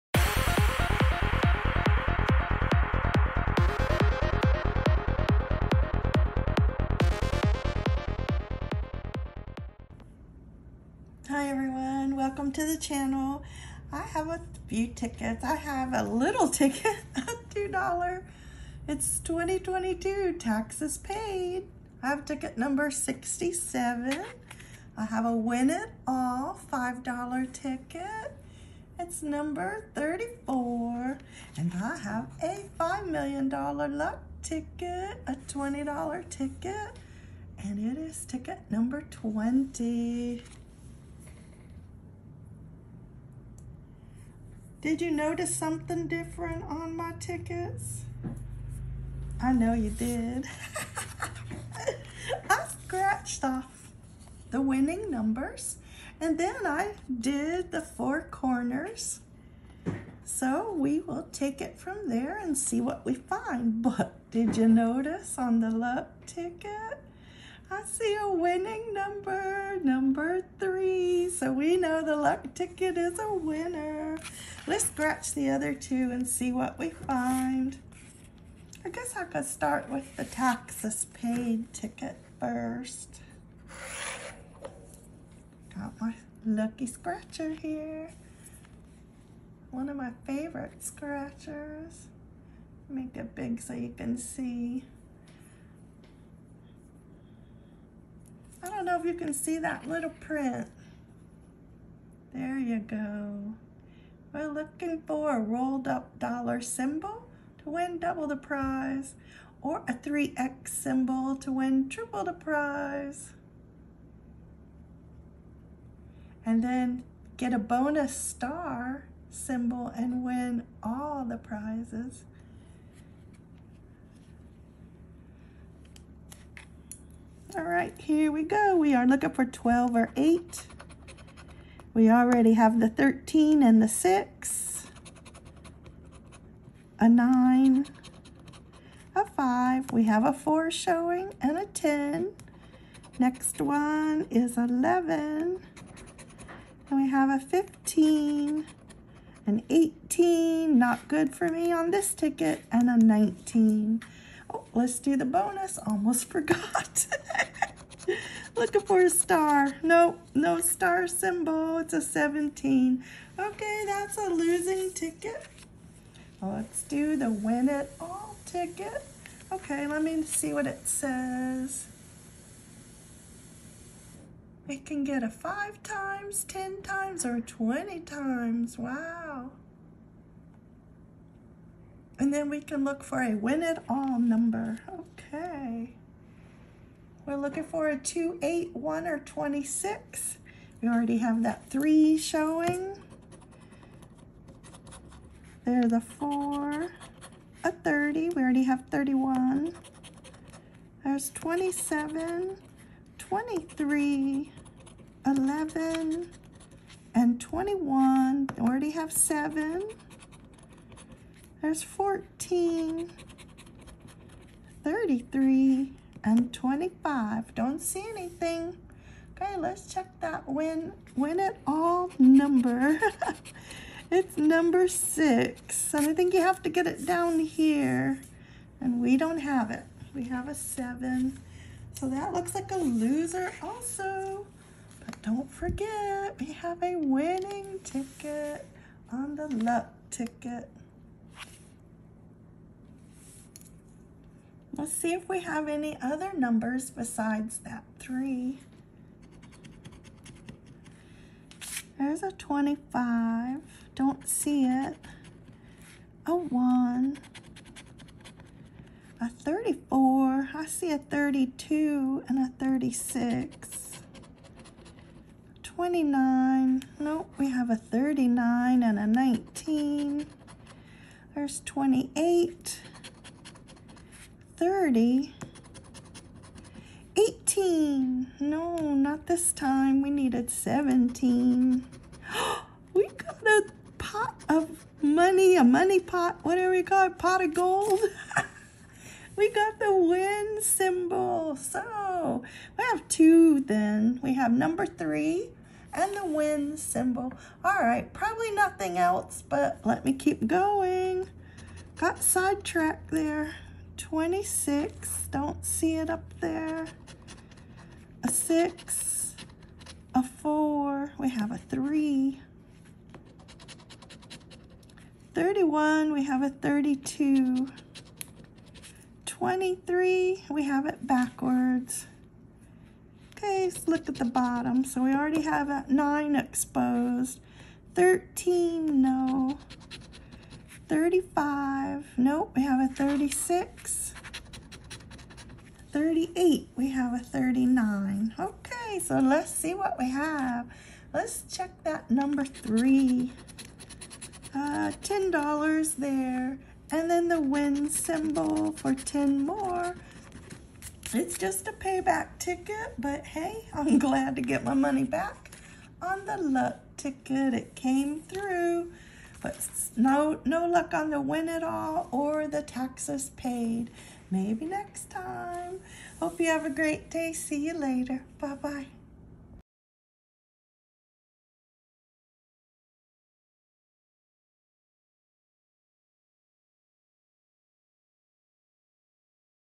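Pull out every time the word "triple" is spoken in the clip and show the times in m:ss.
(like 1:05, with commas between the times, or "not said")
1:51.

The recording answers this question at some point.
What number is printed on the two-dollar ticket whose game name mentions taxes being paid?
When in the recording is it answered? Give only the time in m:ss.
0:22.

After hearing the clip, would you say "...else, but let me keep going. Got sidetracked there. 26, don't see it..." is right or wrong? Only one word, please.
right.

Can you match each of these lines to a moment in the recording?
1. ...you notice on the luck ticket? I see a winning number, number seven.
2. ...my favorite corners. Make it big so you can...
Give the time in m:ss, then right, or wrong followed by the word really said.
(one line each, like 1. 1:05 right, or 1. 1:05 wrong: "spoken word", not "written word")
1. 1:04 wrong: "three", not "seven"
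2. 1:29 wrong: "scratchers", not "corners".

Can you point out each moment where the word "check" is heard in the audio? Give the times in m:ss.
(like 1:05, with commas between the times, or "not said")
3:39, 5:41.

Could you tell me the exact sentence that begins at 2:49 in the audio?
Okay, let me see what it says.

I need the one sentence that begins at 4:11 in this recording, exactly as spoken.
There's a 25, don't see it.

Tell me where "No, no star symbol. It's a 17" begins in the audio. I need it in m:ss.
2:39.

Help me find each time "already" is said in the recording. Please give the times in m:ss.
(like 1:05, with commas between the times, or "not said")
2:12, 5:25.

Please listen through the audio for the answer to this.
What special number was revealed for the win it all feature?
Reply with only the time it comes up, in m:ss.
3:44.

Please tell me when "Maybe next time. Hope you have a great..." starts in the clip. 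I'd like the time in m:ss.
6:04.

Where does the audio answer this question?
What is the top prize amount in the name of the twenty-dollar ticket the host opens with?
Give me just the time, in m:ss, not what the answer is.
0:32.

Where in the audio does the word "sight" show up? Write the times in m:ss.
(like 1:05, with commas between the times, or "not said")
not said.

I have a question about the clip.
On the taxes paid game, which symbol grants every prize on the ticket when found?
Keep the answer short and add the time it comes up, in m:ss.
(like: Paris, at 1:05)
bonus star symbol, at 1:57.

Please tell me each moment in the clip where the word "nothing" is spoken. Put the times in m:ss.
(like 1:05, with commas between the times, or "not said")
4:58.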